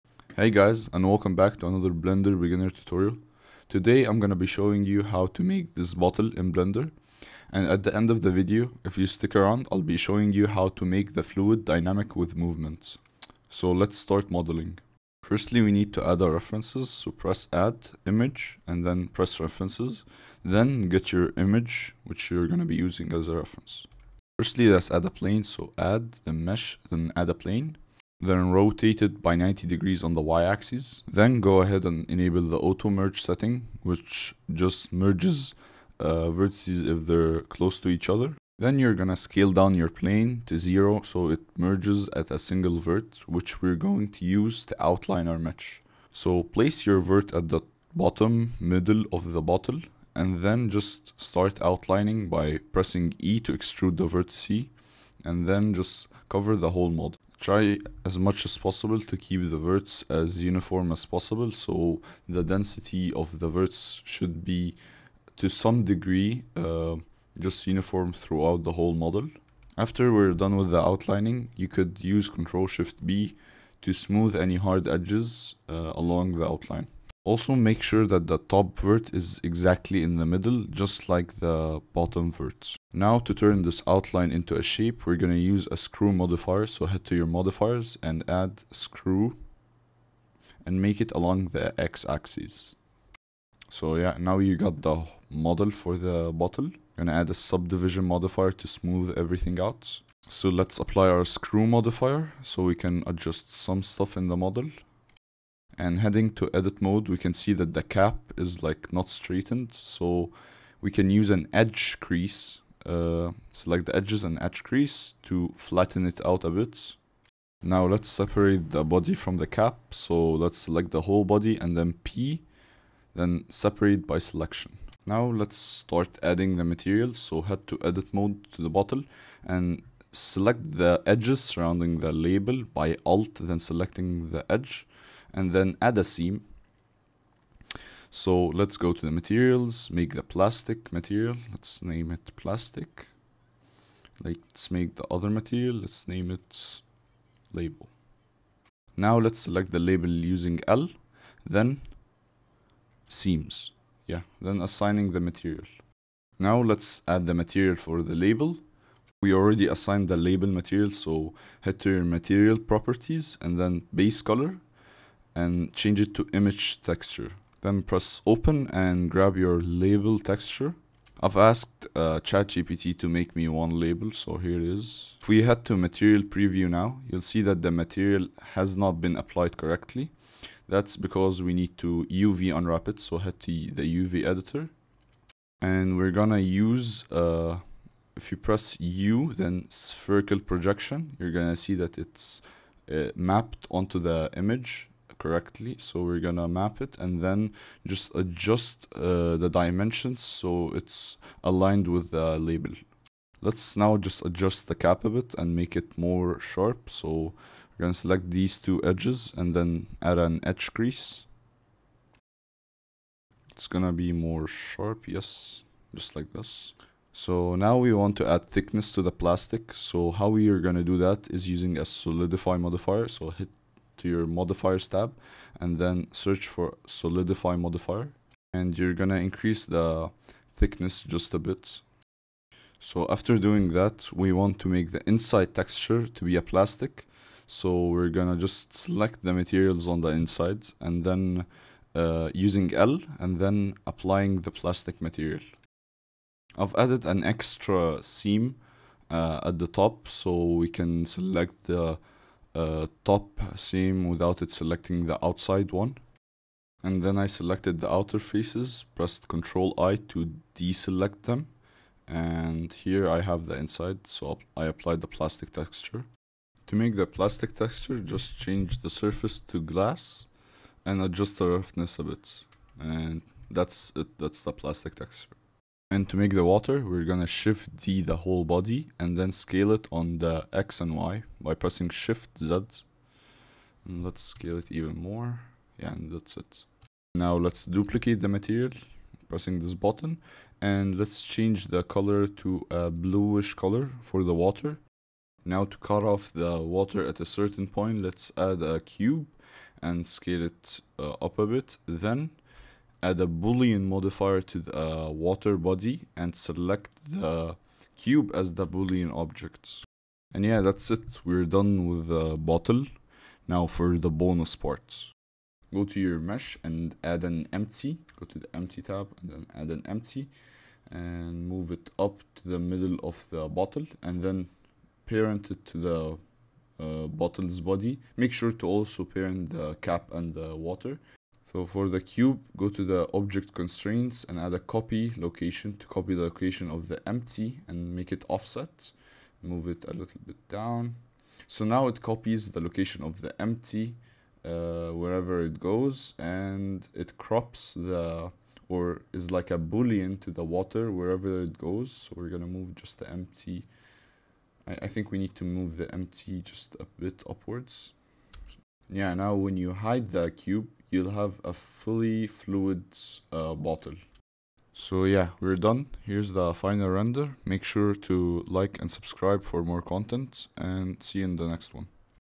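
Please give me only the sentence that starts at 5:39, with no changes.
Move it a little bit down.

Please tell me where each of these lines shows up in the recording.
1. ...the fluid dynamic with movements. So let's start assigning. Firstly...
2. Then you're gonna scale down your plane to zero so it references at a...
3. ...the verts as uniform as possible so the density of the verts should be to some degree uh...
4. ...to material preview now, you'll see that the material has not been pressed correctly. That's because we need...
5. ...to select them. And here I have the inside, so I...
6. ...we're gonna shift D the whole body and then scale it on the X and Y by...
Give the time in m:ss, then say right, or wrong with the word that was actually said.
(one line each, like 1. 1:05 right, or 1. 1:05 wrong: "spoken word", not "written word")
1. 0:11 wrong: "modeling", not "assigning"
2. 0:38 wrong: "merges", not "references"
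3. 0:59 right
4. 2:55 wrong: "applied", not "pressed"
5. 4:20 wrong: "deselect", not "select"
6. 4:36 right.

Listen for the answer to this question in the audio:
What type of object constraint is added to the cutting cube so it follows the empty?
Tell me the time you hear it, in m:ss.
5:34.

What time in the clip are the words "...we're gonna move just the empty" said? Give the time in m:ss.
5:52.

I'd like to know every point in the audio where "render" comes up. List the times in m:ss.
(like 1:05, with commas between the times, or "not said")
6:06.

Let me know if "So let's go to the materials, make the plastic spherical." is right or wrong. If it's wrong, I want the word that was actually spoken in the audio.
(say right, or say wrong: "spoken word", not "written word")
wrong: "material", not "spherical".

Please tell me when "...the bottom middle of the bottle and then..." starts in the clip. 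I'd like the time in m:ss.
0:47.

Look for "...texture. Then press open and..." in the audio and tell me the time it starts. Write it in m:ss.
2:46.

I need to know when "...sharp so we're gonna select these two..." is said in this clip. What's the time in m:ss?
3:26.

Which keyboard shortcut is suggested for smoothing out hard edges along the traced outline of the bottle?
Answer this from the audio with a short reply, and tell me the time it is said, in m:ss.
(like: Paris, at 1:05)
Ctrl Shift B, at 1:12.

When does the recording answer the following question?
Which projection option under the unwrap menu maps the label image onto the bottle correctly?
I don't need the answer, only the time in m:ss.
3:09.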